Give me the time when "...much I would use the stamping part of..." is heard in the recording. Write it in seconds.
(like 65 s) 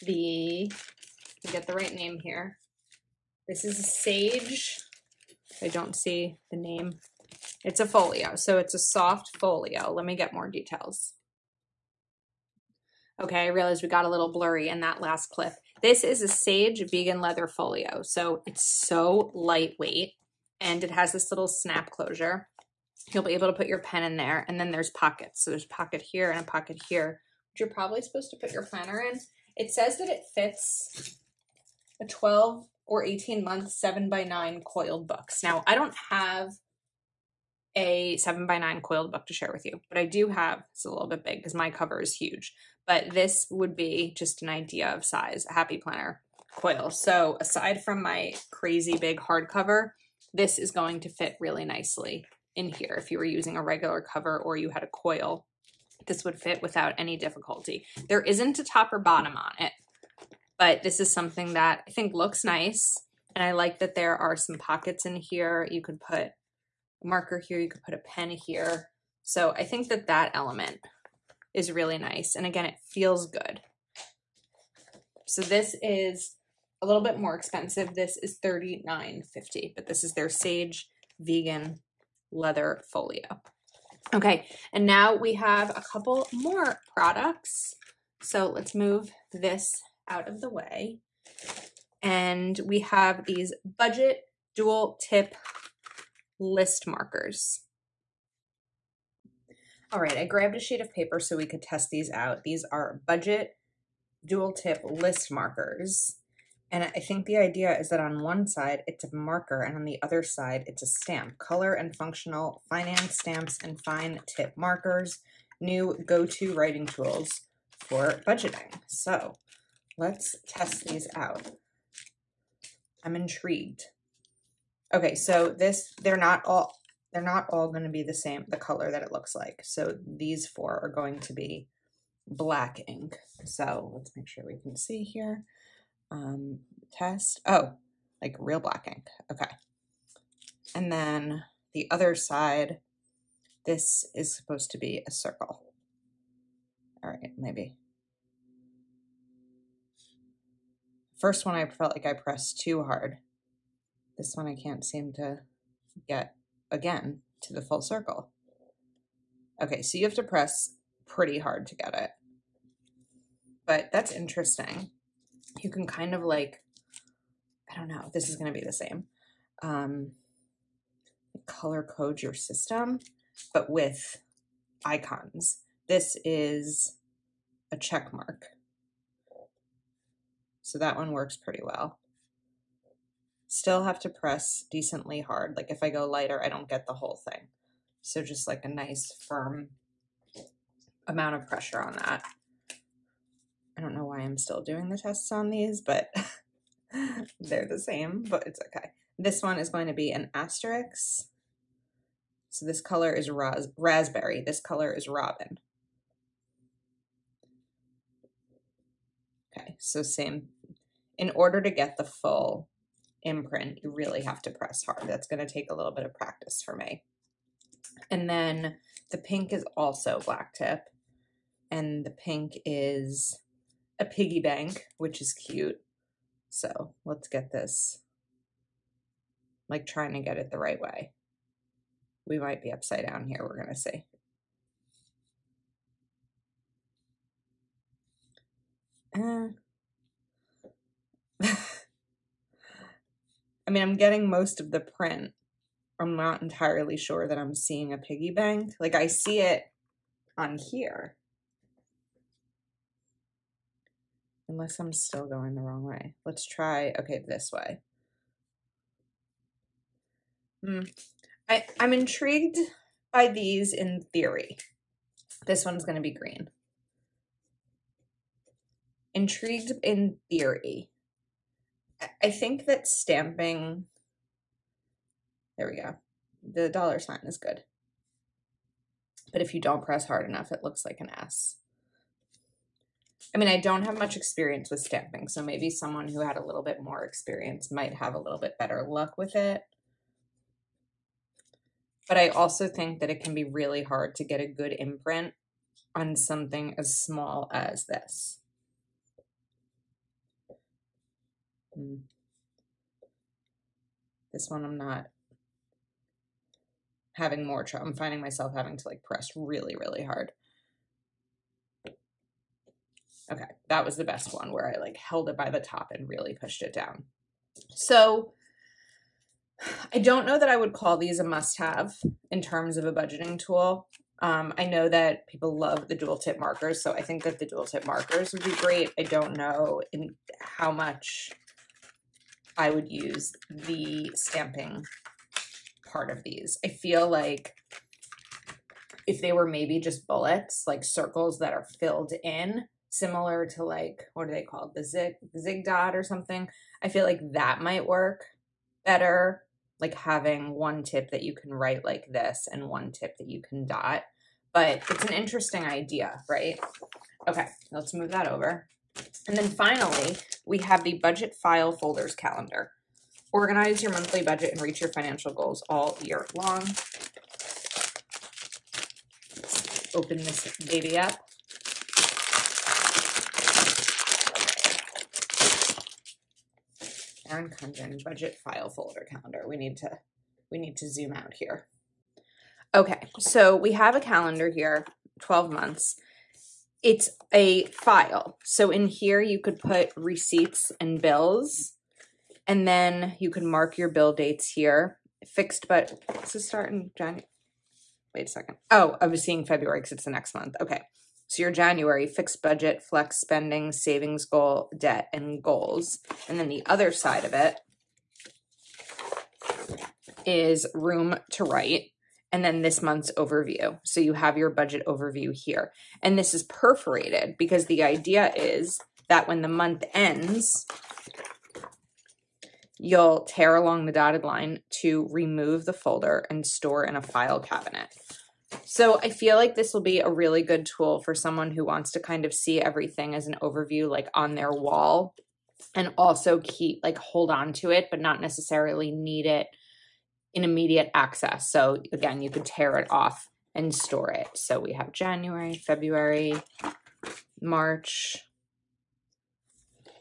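330 s.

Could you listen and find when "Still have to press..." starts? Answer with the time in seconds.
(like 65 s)
183 s.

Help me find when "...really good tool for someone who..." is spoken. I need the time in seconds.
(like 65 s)
430 s.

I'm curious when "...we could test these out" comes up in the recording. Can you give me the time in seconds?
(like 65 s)
101 s.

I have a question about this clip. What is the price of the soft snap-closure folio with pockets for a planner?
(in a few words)
$39.50.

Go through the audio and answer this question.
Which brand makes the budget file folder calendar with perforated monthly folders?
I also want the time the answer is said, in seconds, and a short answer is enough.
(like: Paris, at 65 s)
Erin Condren, at 377 s.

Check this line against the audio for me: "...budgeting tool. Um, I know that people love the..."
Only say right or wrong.
right.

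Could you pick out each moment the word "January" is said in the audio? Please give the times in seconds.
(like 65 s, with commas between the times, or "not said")
396 s, 401 s, 444 s.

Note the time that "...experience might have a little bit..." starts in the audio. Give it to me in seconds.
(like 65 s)
287 s.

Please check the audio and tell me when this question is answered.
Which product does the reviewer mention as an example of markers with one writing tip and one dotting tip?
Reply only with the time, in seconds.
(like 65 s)
345 s.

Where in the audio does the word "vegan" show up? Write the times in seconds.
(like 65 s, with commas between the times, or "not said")
16 s, 81 s.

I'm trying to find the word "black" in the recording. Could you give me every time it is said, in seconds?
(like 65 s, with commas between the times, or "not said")
132 s, 138 s, 220 s.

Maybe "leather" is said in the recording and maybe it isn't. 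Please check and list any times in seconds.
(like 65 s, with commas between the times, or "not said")
17 s, 82 s.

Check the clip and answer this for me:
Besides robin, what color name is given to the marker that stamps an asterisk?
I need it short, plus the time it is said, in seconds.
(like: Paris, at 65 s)
Raspberry, at 203 s.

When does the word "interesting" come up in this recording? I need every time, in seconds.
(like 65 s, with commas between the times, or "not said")
164 s, 355 s.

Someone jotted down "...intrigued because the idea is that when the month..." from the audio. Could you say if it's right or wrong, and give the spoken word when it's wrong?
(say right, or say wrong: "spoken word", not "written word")
wrong: "perforated", not "intrigued".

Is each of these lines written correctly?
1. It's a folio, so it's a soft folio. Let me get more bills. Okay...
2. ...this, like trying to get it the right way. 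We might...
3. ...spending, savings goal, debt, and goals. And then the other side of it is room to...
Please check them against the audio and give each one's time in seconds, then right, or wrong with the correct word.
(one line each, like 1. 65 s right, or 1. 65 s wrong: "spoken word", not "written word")
1. 7 s wrong: "details", not "bills"
2. 227 s right
3. 403 s right.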